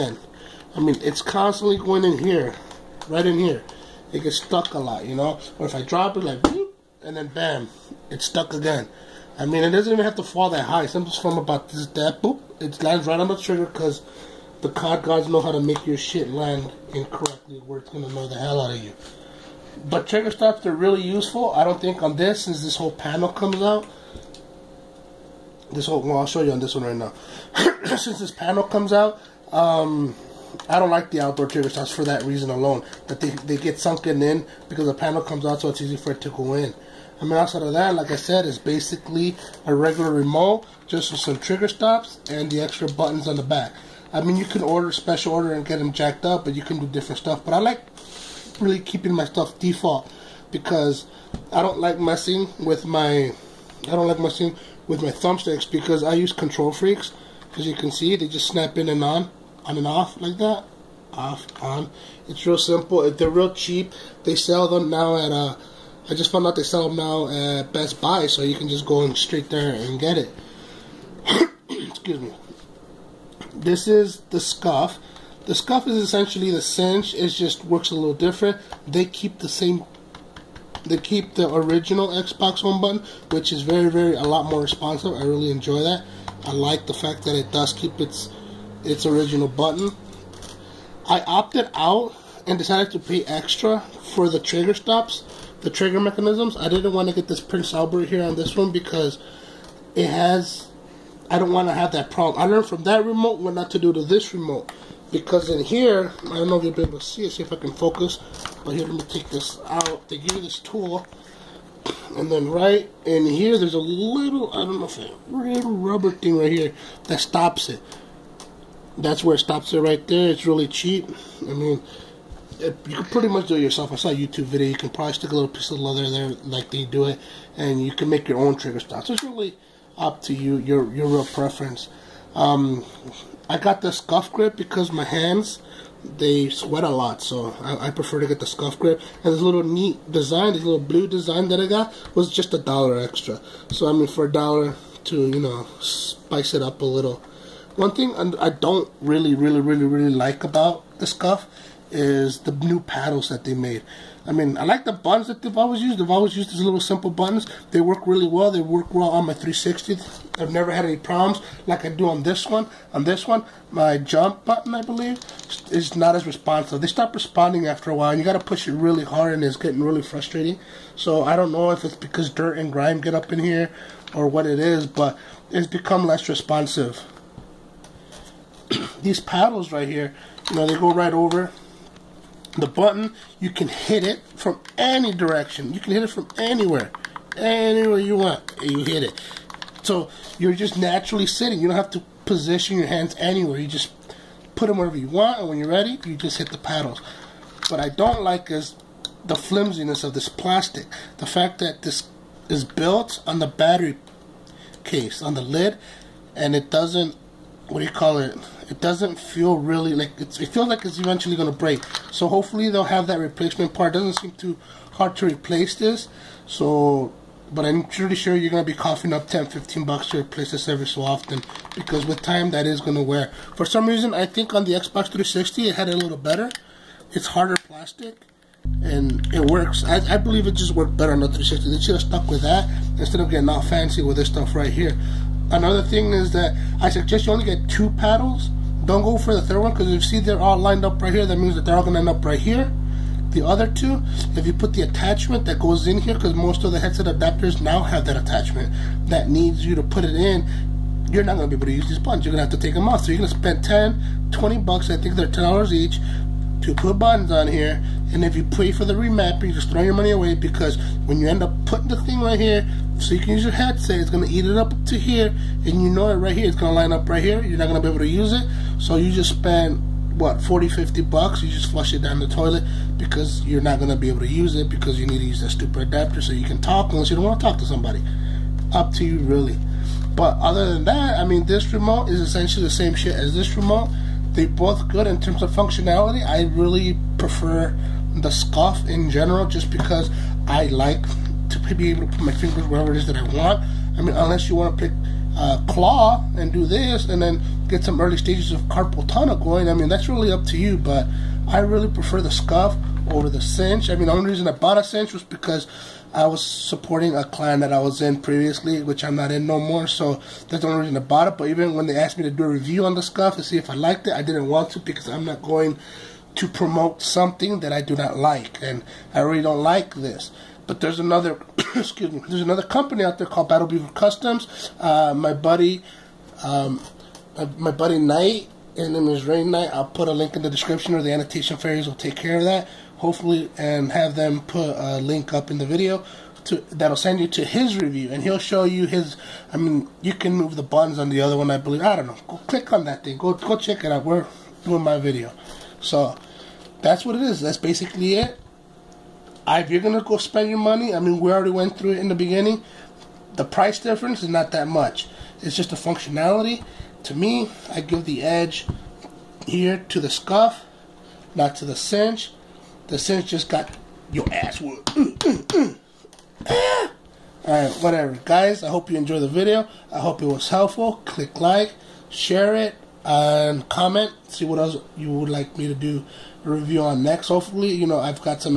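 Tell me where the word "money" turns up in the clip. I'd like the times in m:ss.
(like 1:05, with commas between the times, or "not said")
4:19, 5:50.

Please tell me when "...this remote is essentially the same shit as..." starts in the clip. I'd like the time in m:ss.
4:41.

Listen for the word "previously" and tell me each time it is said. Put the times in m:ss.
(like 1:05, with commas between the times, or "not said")
5:08.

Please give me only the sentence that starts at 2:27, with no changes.
One thing I don't really, really, really, really like about the Scuf is the new paddles that they made.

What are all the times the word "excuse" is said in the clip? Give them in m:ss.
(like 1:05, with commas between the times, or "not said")
1:11, 5:21.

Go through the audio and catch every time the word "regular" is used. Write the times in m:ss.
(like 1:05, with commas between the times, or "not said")
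0:39.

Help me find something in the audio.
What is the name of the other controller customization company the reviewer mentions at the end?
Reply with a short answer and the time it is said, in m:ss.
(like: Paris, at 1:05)
Battle Beaver Customs, at 5:23.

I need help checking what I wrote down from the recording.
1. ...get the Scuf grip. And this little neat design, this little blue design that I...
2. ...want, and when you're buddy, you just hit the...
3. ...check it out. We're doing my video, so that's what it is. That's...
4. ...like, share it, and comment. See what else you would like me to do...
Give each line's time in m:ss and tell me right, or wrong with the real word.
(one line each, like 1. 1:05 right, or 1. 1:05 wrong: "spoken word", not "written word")
1. 2:18 right
2. 3:15 wrong: "ready", not "buddy"
3. 5:43 right
4. 6:11 right.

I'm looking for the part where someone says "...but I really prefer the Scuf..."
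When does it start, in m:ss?
5:00.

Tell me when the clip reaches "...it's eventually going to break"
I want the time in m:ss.
3:30.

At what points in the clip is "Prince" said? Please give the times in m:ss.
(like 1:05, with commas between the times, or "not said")
1:37.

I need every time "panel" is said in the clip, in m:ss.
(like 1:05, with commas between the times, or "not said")
0:22, 0:28, 0:34.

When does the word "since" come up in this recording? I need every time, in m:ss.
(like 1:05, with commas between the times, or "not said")
0:22, 0:27.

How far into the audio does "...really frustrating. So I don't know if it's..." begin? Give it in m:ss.
2:49.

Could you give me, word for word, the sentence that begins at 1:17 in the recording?
It just works a little different.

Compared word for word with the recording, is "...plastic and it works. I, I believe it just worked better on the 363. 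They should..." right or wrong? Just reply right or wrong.
wrong.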